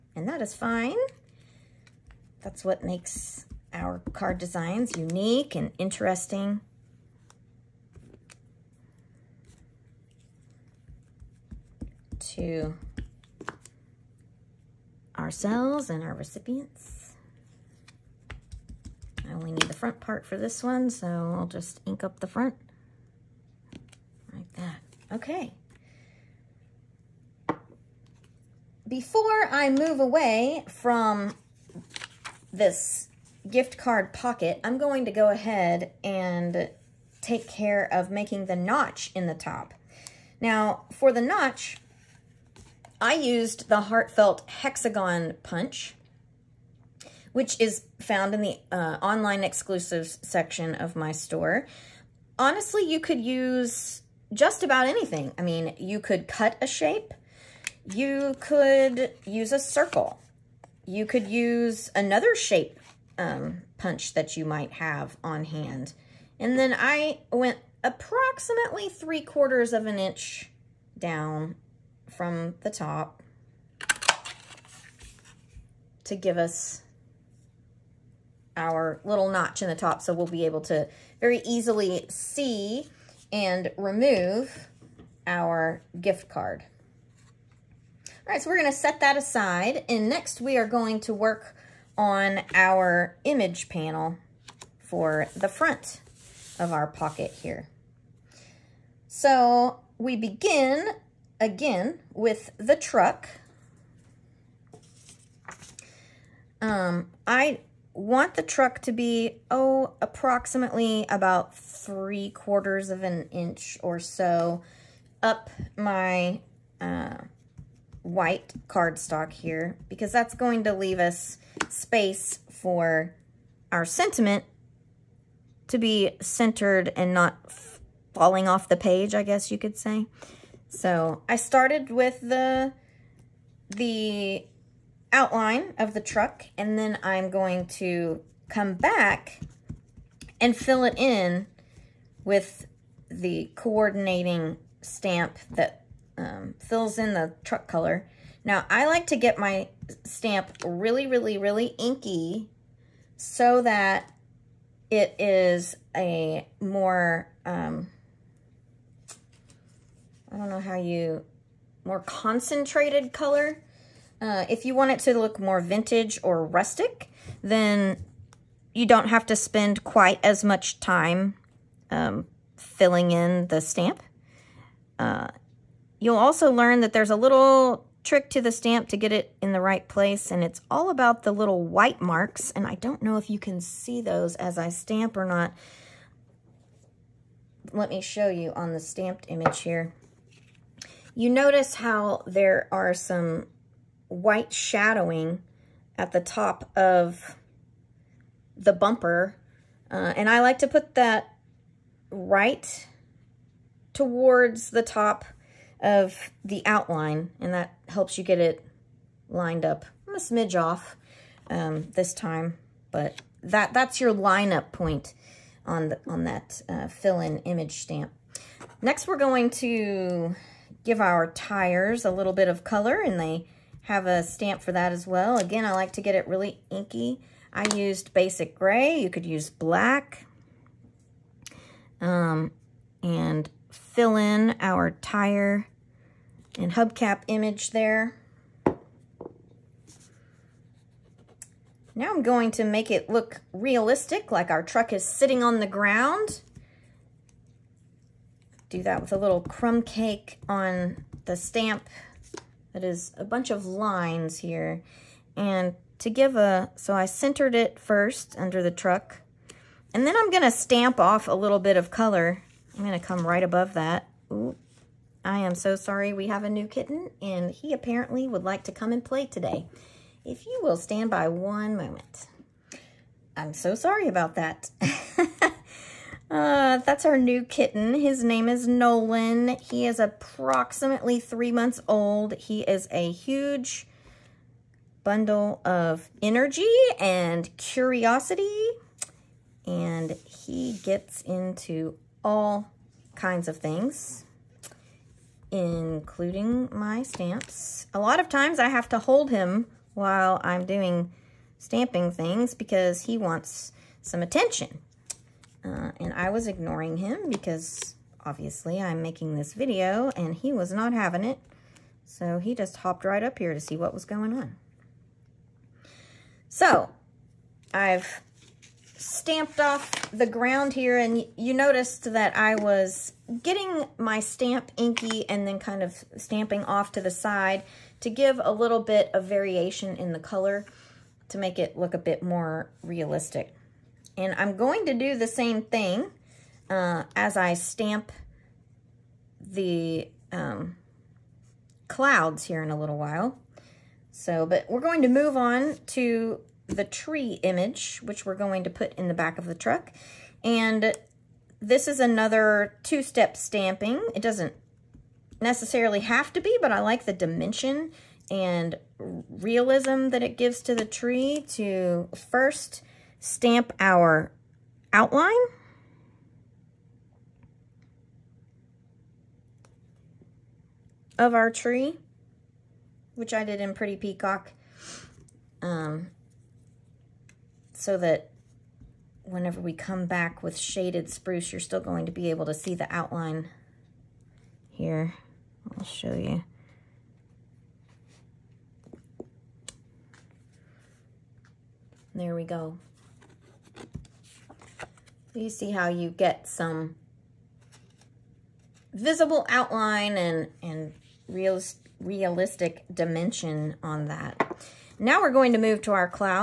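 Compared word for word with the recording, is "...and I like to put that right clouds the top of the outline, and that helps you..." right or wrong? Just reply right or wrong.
wrong.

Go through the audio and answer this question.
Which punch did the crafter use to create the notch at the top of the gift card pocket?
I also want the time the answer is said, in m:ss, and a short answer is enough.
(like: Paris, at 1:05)
Heartfelt Hexagon Punch, at 0:43.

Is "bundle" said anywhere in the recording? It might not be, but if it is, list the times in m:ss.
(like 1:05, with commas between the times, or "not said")
4:45.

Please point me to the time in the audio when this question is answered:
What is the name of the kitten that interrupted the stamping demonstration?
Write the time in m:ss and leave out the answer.
4:38.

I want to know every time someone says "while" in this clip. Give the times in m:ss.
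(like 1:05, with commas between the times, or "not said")
4:59, 5:42.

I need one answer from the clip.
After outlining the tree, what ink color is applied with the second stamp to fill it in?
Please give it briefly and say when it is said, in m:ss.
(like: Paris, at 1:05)
Shaded Spruce, at 6:20.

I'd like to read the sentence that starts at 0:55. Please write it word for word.
I mean, you could cut a shape, you could use a circle.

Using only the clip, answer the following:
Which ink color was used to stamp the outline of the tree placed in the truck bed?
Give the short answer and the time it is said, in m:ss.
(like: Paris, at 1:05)
Pretty Peacock, at 6:13.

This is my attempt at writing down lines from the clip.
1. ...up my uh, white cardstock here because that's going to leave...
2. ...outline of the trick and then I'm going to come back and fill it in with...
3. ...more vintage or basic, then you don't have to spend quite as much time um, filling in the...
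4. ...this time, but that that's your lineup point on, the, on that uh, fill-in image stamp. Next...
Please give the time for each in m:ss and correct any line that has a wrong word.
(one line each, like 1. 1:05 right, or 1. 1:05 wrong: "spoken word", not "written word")
1. 1:55 right
2. 2:15 wrong: "truck", not "trick"
3. 2:45 wrong: "rustic", not "basic"
4. 3:31 right.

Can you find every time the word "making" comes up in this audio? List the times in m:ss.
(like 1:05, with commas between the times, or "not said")
0:38, 5:09.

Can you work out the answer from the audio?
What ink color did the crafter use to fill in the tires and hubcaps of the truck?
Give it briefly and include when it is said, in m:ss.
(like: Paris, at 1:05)
Basic Gray, at 3:48.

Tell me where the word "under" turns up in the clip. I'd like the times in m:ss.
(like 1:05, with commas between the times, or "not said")
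4:18.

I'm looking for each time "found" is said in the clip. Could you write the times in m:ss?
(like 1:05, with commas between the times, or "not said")
0:48.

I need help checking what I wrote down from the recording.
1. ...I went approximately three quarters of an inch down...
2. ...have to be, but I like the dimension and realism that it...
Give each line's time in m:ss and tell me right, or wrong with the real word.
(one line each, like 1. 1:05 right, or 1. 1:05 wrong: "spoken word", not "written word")
1. 1:06 right
2. 5:56 right.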